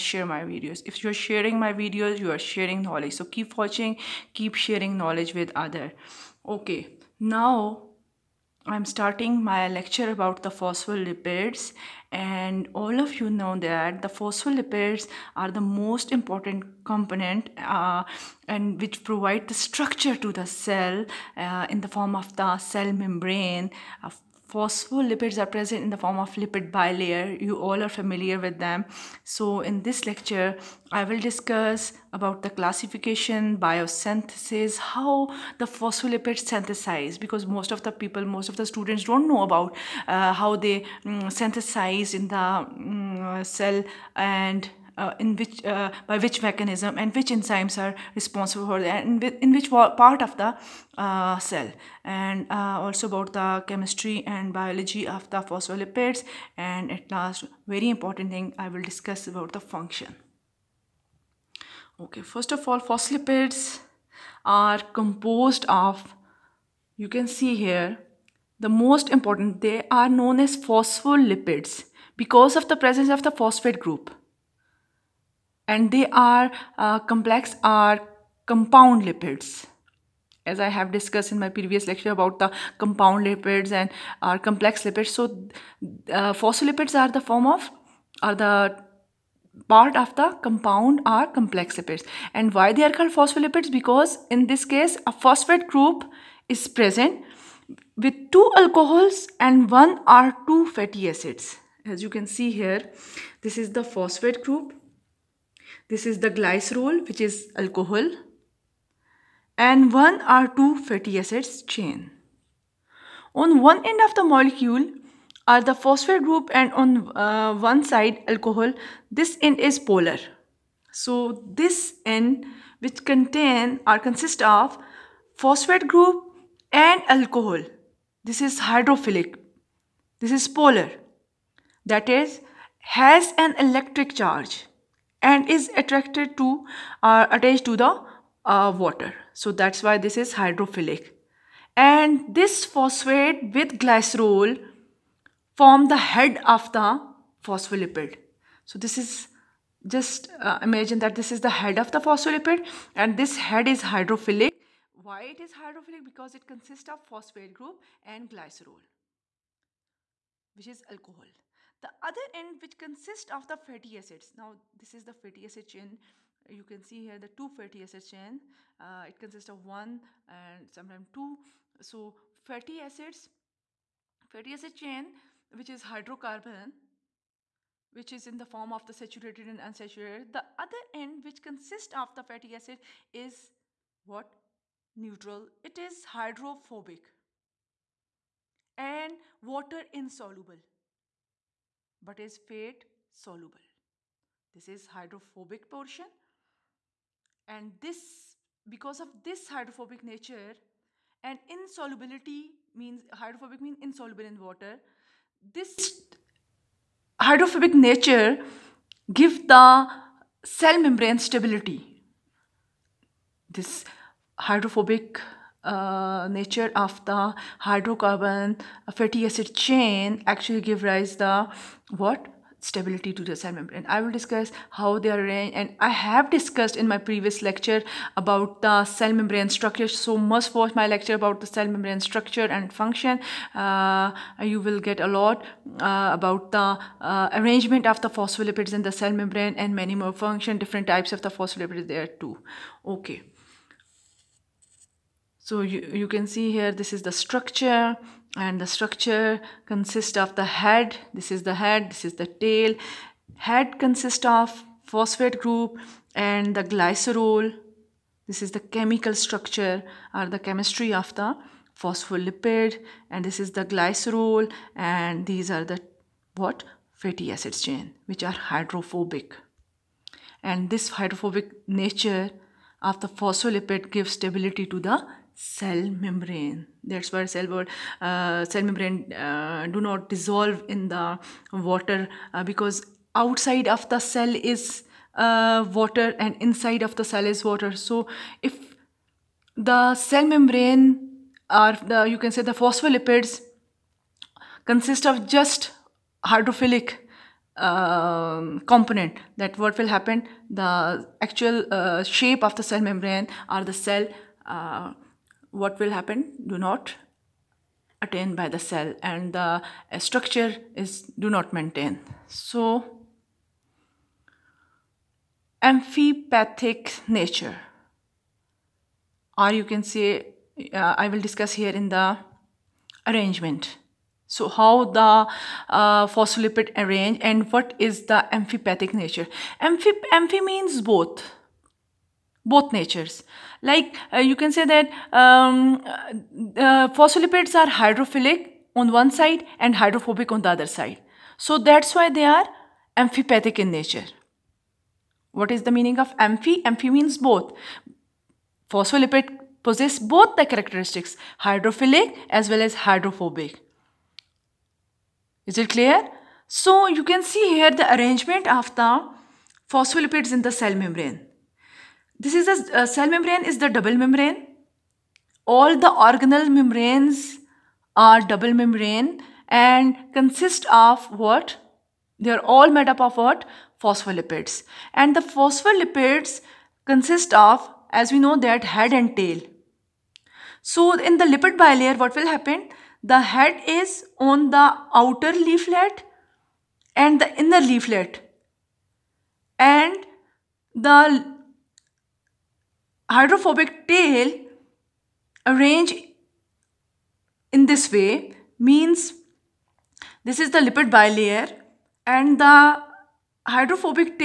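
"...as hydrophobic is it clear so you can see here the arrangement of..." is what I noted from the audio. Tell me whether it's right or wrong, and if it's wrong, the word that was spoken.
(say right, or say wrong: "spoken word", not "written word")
right.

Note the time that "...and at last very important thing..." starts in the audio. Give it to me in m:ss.
0:56.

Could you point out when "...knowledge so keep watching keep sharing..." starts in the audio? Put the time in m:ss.
0:02.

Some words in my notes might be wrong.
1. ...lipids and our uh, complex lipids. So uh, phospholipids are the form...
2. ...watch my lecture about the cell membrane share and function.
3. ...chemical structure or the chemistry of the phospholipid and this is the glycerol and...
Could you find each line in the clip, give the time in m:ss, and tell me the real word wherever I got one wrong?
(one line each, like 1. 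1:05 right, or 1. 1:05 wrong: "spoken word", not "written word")
1. 1:23 right
2. 3:50 wrong: "structure", not "share"
3. 4:18 right.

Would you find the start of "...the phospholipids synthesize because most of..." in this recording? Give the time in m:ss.
0:35.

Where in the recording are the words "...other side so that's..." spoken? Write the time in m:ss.
5:40.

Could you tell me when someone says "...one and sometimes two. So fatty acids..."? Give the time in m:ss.
2:49.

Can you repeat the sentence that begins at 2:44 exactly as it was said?
Now this is the fatty acid chain.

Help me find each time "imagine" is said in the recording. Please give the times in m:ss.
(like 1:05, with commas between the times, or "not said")
2:30.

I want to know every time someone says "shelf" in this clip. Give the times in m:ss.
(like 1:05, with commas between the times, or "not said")
not said.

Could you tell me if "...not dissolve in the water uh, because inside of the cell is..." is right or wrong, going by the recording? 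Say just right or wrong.
wrong.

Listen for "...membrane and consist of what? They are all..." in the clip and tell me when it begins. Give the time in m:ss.
6:08.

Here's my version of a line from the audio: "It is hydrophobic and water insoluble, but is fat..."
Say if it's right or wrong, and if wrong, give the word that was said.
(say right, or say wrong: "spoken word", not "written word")
right.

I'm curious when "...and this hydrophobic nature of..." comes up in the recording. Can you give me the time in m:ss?
4:30.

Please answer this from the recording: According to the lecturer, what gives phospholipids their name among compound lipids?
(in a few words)
Presence of the phosphate group.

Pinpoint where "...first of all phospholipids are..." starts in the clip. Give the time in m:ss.
1:02.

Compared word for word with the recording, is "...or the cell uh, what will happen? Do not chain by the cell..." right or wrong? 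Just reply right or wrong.
wrong.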